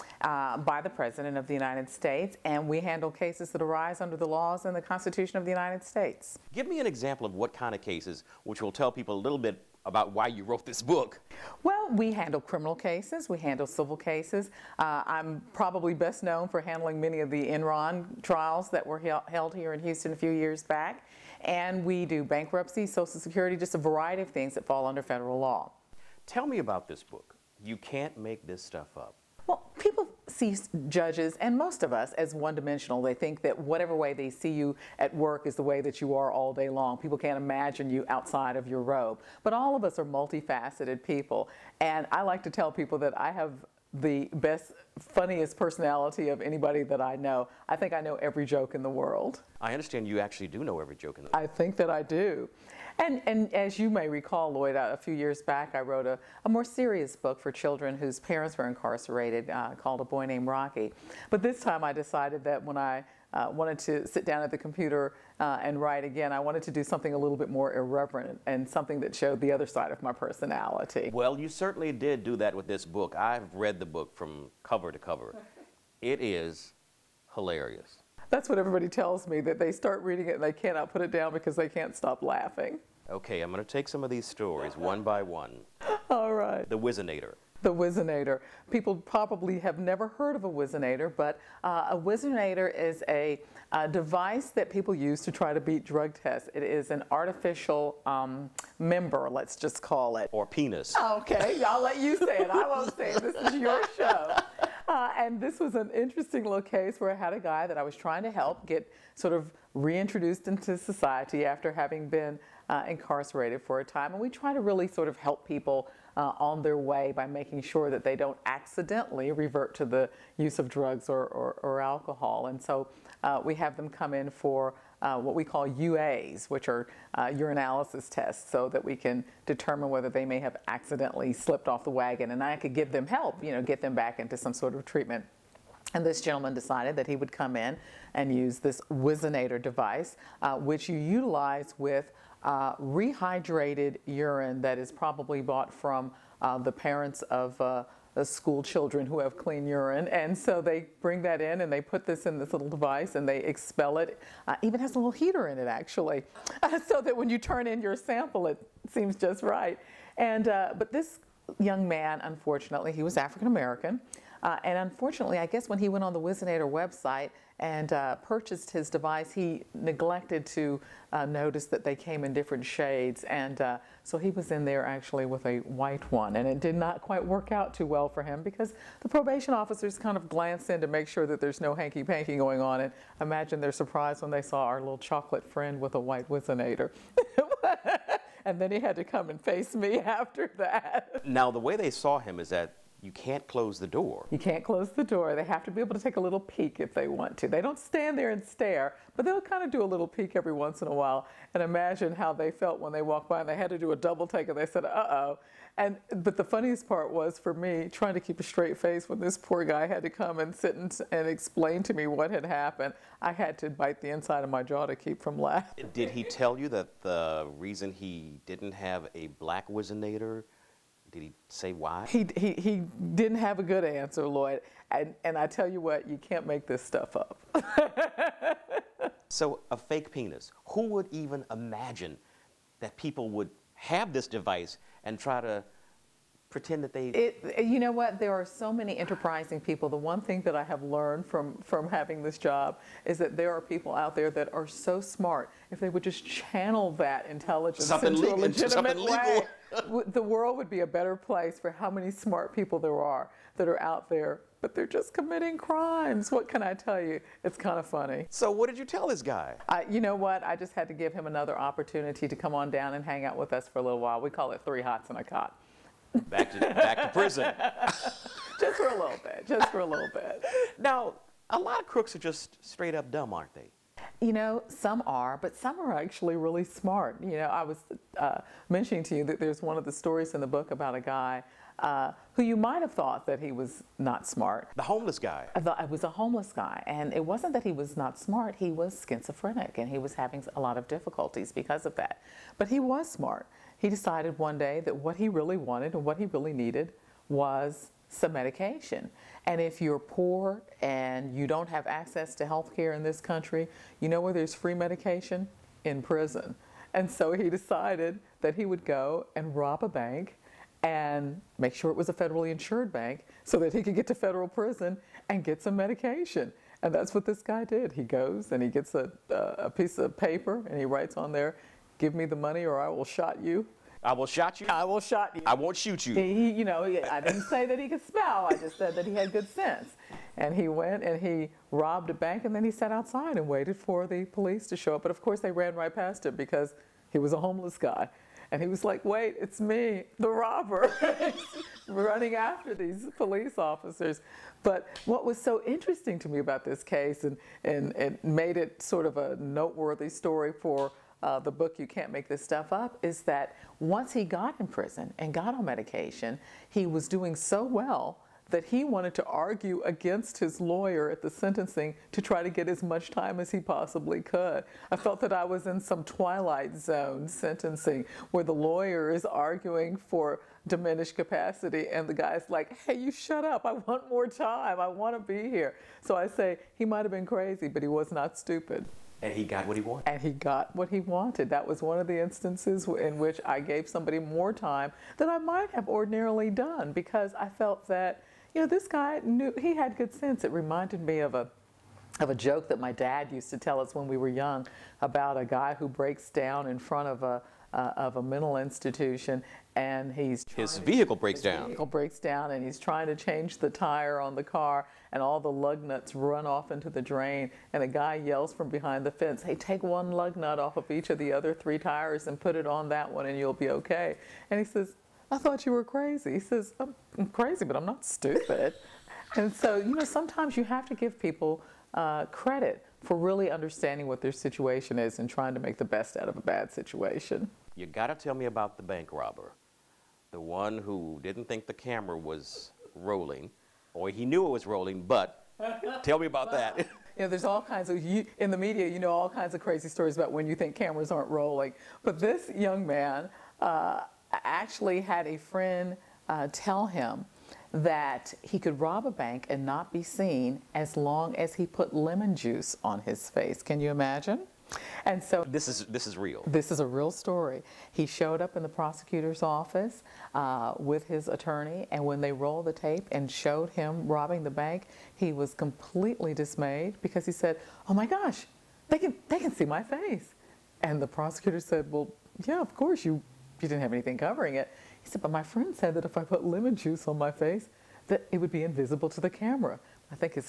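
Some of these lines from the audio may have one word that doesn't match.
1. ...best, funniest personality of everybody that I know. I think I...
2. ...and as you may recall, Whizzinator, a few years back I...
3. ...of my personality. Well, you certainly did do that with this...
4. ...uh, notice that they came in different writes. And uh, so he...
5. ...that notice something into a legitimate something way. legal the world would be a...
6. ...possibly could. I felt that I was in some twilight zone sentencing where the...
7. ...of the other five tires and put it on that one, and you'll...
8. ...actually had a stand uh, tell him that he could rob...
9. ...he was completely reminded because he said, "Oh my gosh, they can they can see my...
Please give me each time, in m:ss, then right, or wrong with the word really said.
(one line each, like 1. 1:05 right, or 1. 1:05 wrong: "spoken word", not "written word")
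1. 0:44 wrong: "anybody", not "everybody"
2. 0:53 wrong: "Lloyd", not "Whizzinator"
3. 1:09 right
4. 2:51 wrong: "shades", not "writes"
5. 4:06 wrong: "intelligence", not "notice"
6. 6:03 right
7. 6:51 wrong: "three", not "five"
8. 7:24 wrong: "friend", not "stand"
9. 7:45 wrong: "dismayed", not "reminded".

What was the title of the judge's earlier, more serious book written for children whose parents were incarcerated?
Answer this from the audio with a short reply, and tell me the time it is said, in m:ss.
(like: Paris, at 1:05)
A Boy Named Rocky, at 1:00.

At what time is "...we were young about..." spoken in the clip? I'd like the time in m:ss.
6:34.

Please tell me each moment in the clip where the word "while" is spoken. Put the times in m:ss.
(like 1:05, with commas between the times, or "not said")
3:20, 4:23.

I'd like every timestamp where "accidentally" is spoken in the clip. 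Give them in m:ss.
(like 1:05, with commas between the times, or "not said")
1:58, 2:10.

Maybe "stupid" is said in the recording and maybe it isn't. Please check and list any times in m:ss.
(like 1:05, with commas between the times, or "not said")
6:18, 6:58.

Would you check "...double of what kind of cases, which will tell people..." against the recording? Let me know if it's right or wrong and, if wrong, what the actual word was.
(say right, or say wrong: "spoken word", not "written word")
wrong: "example", not "double".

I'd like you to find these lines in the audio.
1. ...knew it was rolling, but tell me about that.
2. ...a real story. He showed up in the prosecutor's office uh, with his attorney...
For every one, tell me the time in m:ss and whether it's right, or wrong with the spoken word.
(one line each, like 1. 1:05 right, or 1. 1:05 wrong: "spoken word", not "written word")
1. 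7:14 right
2. 7:36 right.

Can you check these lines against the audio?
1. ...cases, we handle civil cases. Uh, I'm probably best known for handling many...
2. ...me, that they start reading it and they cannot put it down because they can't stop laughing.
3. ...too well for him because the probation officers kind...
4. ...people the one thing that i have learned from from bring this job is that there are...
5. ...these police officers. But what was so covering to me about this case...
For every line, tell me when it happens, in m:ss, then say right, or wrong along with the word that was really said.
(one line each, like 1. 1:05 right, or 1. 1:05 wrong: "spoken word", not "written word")
1. 0:12 right
2. 1:19 right
3. 2:57 right
4. 3:59 wrong: "having", not "bring"
5. 5:42 wrong: "interesting", not "covering".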